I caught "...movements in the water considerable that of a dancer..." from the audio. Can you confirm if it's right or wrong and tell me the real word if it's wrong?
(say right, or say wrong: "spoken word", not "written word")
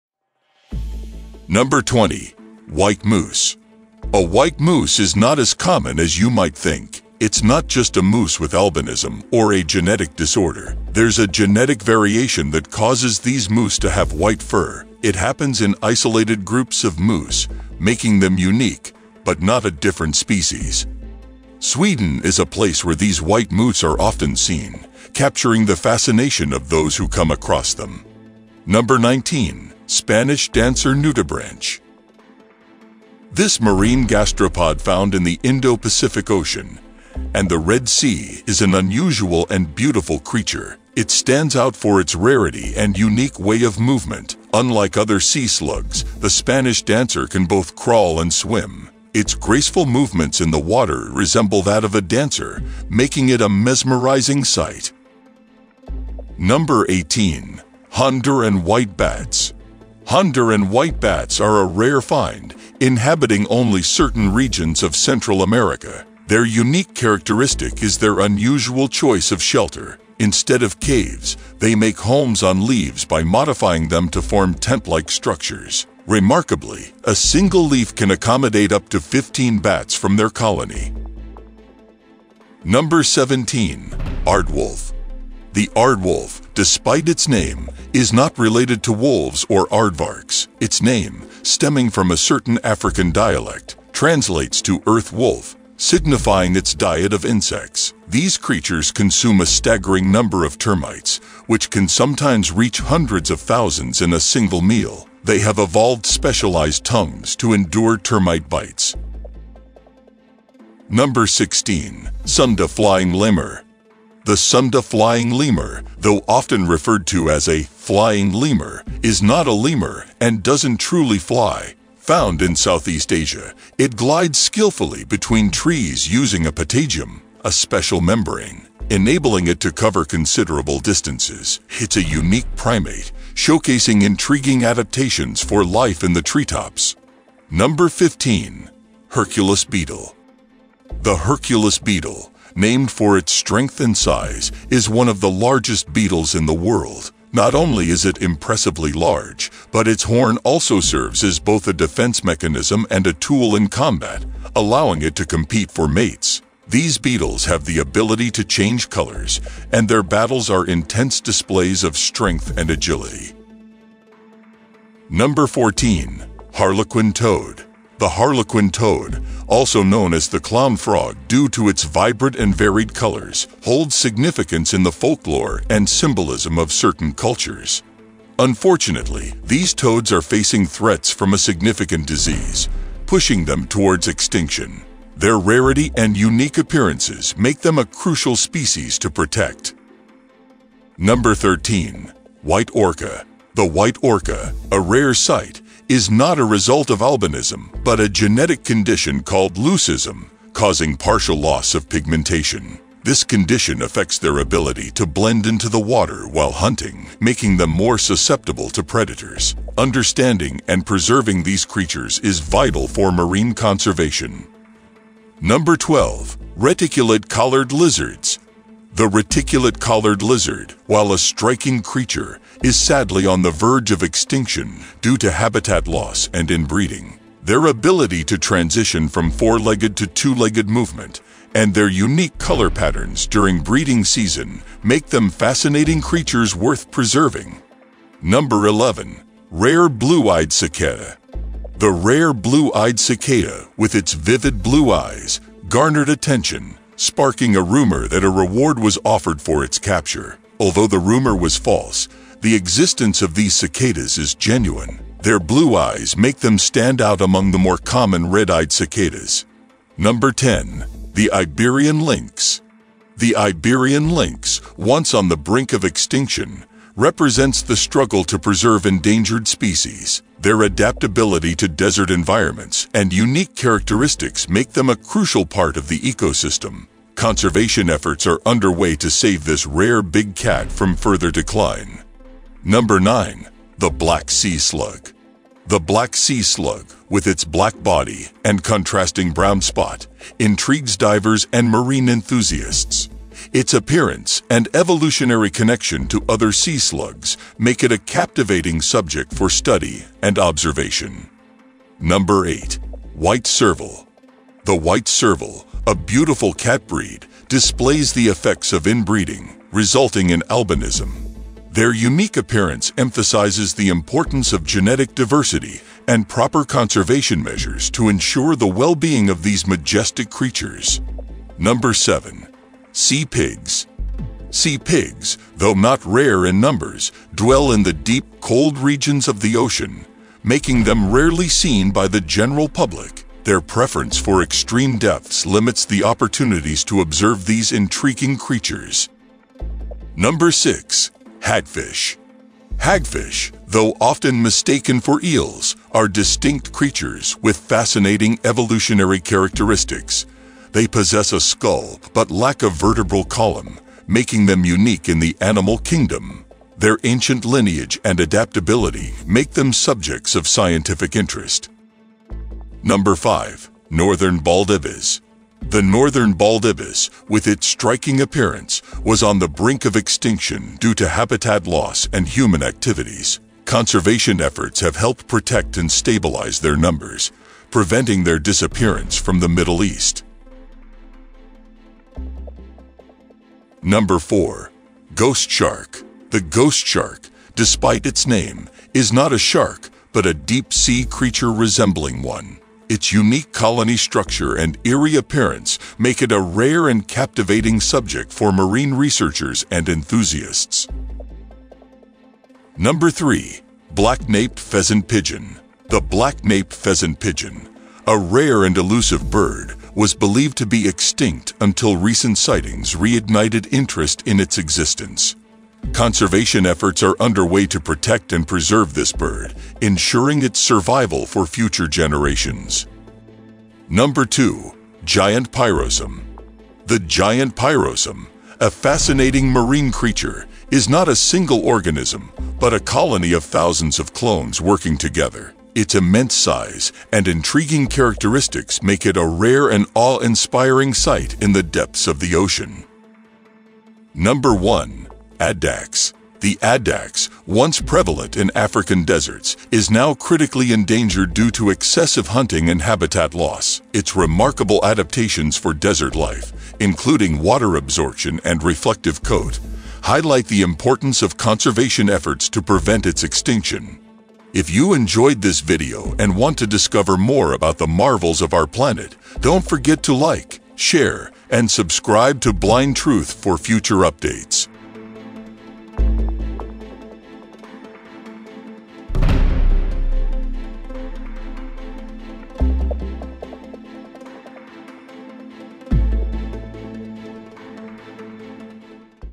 wrong: "resemble", not "considerable".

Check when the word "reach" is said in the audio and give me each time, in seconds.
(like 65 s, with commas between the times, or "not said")
102 s.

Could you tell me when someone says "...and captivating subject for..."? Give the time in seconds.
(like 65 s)
396 s.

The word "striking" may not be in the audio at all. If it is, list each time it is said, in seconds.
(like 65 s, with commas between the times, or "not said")
221 s, 367 s.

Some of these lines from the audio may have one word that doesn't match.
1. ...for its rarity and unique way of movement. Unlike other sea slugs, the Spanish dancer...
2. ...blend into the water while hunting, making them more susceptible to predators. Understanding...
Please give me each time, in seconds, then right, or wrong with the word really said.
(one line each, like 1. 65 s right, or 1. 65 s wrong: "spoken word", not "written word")
1. 41 s right
2. 205 s right.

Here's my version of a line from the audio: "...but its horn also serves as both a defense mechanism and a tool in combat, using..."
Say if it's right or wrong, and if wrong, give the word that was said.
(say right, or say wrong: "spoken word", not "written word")
wrong: "allowing", not "using".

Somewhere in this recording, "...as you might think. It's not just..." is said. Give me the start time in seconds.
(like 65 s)
5 s.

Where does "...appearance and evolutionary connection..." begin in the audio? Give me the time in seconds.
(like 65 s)
293 s.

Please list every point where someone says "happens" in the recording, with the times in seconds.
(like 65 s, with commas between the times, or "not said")
15 s.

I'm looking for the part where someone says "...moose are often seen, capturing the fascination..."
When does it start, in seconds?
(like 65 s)
23 s.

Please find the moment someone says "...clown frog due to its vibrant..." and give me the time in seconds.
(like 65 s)
170 s.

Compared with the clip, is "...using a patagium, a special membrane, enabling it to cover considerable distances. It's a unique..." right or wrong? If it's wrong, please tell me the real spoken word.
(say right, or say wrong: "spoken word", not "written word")
right.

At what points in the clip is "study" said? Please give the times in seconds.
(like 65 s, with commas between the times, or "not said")
299 s.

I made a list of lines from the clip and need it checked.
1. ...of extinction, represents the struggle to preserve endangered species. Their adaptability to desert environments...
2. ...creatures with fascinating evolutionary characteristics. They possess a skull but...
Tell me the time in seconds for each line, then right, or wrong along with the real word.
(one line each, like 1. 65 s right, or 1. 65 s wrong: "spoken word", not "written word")
1. 265 s right
2. 346 s right.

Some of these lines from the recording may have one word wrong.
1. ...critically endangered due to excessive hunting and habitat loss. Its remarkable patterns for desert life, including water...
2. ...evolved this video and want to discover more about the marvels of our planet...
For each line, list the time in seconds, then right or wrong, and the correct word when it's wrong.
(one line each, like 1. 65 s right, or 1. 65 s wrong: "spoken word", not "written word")
1. 450 s wrong: "adaptations", not "patterns"
2. 464 s wrong: "enjoyed", not "evolved".